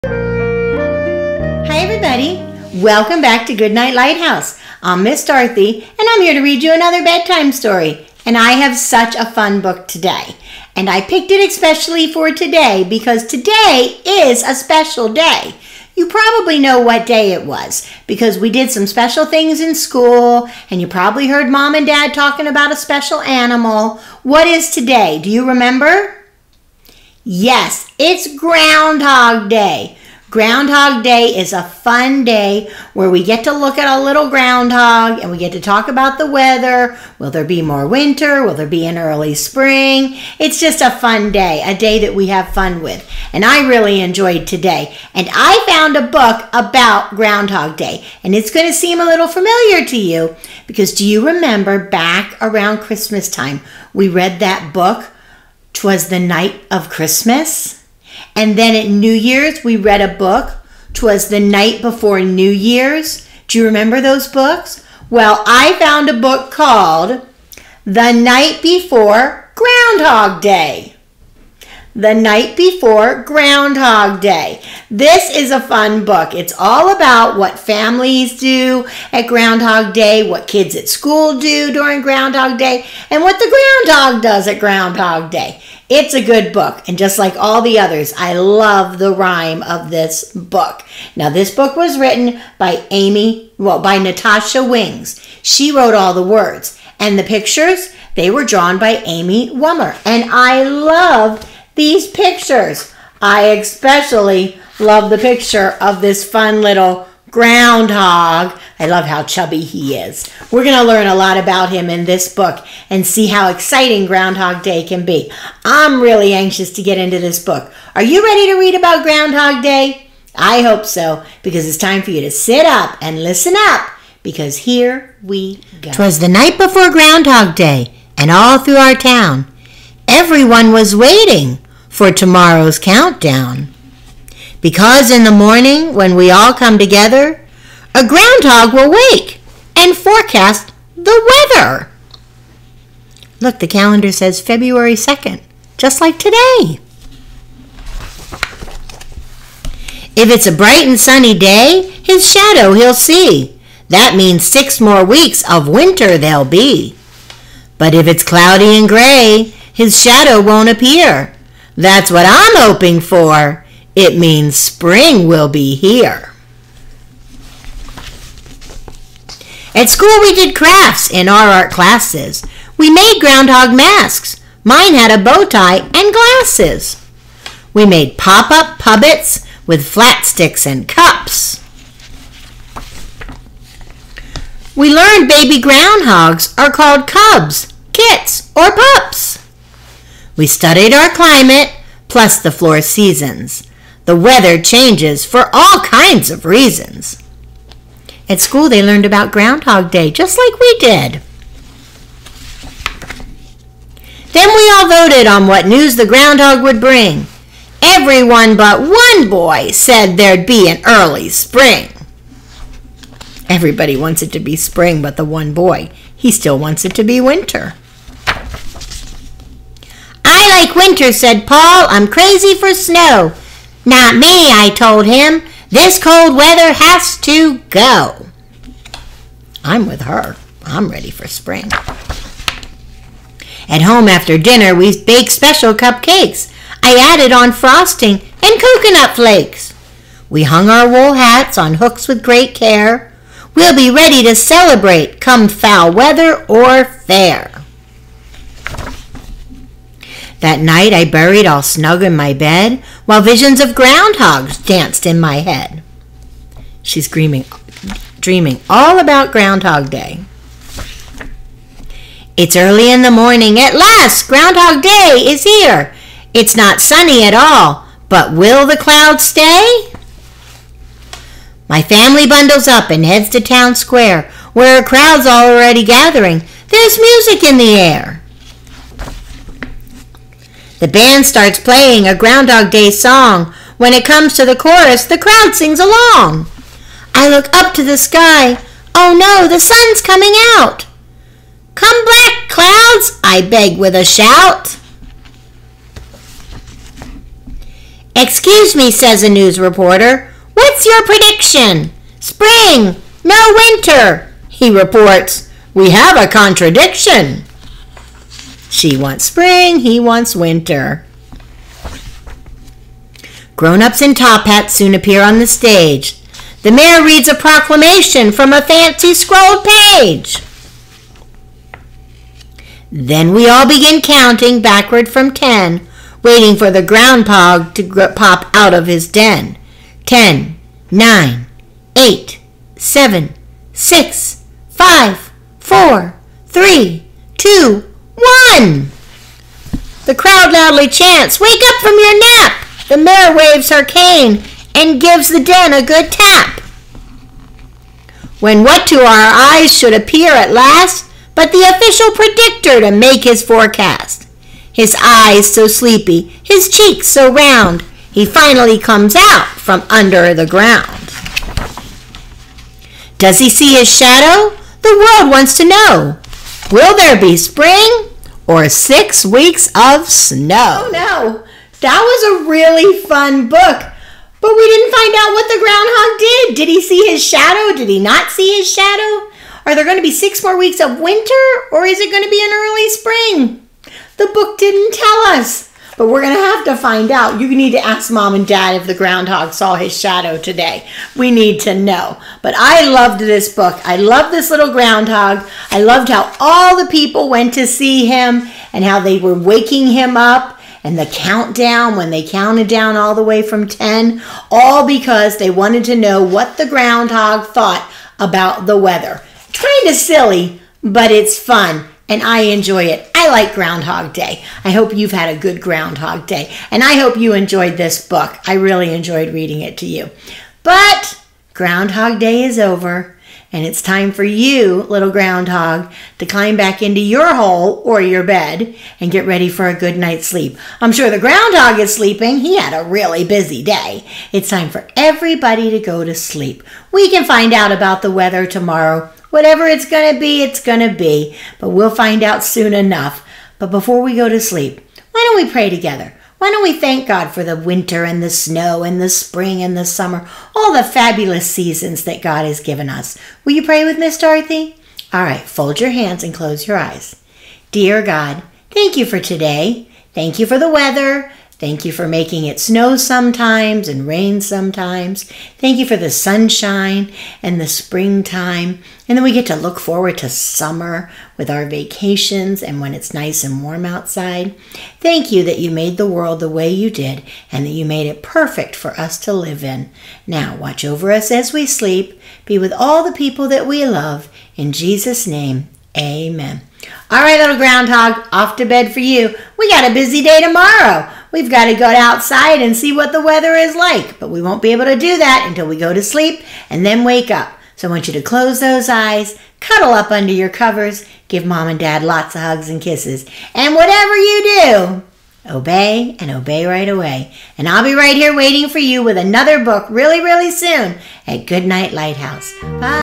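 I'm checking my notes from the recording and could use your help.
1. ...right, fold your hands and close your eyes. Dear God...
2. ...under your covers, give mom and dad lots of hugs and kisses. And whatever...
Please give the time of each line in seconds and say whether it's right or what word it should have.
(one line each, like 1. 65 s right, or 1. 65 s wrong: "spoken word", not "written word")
1. 455 s right
2. 500 s right.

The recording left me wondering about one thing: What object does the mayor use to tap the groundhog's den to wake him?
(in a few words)
Her cane.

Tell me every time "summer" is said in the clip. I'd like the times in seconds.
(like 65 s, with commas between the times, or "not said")
449 s, 470 s.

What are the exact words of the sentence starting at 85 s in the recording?
It's a good book, and just like all the others, I love the rhyme of this book.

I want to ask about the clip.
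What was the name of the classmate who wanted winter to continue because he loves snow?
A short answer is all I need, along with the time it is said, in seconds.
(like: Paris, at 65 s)
Paul, at 221 s.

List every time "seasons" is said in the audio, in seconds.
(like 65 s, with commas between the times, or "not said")
192 s, 451 s.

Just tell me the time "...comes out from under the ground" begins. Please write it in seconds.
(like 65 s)
358 s.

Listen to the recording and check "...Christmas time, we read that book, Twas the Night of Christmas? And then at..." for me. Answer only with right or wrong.
right.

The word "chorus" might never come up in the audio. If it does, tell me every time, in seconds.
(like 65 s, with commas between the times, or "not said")
284 s.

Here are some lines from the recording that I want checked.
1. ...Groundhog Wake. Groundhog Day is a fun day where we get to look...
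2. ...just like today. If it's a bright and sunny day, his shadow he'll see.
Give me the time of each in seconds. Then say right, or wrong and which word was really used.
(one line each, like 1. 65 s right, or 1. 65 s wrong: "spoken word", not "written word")
1. 28 s wrong: "Day", not "Wake"
2. 145 s right.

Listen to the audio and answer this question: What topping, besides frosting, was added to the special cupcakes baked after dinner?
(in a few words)
Coconut flakes.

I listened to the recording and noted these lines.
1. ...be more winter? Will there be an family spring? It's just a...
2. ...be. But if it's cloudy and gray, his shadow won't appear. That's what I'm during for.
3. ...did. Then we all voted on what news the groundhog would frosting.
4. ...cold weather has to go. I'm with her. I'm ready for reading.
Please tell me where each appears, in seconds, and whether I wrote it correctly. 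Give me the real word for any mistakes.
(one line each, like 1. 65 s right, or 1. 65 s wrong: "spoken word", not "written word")
1. 37 s wrong: "early", not "family"
2. 156 s wrong: "hoping", not "during"
3. 200 s wrong: "bring", not "frosting"
4. 226 s wrong: "spring", not "reading".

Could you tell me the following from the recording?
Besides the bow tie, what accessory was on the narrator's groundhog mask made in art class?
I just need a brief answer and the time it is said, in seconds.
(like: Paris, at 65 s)
Glasses, at 176 s.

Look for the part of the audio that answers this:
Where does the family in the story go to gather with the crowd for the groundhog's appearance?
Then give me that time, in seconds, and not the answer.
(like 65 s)
273 s.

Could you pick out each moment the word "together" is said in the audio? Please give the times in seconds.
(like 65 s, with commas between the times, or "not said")
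136 s, 445 s.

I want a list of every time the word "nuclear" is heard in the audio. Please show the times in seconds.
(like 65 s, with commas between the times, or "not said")
not said.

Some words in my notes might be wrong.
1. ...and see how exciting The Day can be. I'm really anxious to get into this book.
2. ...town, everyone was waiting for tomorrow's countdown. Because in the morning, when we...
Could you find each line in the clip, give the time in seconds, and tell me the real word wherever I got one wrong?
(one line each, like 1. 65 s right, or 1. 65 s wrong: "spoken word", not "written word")
1. 112 s wrong: "Groundhog", not "The"
2. 128 s right.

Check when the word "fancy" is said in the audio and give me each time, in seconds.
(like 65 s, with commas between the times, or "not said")
318 s.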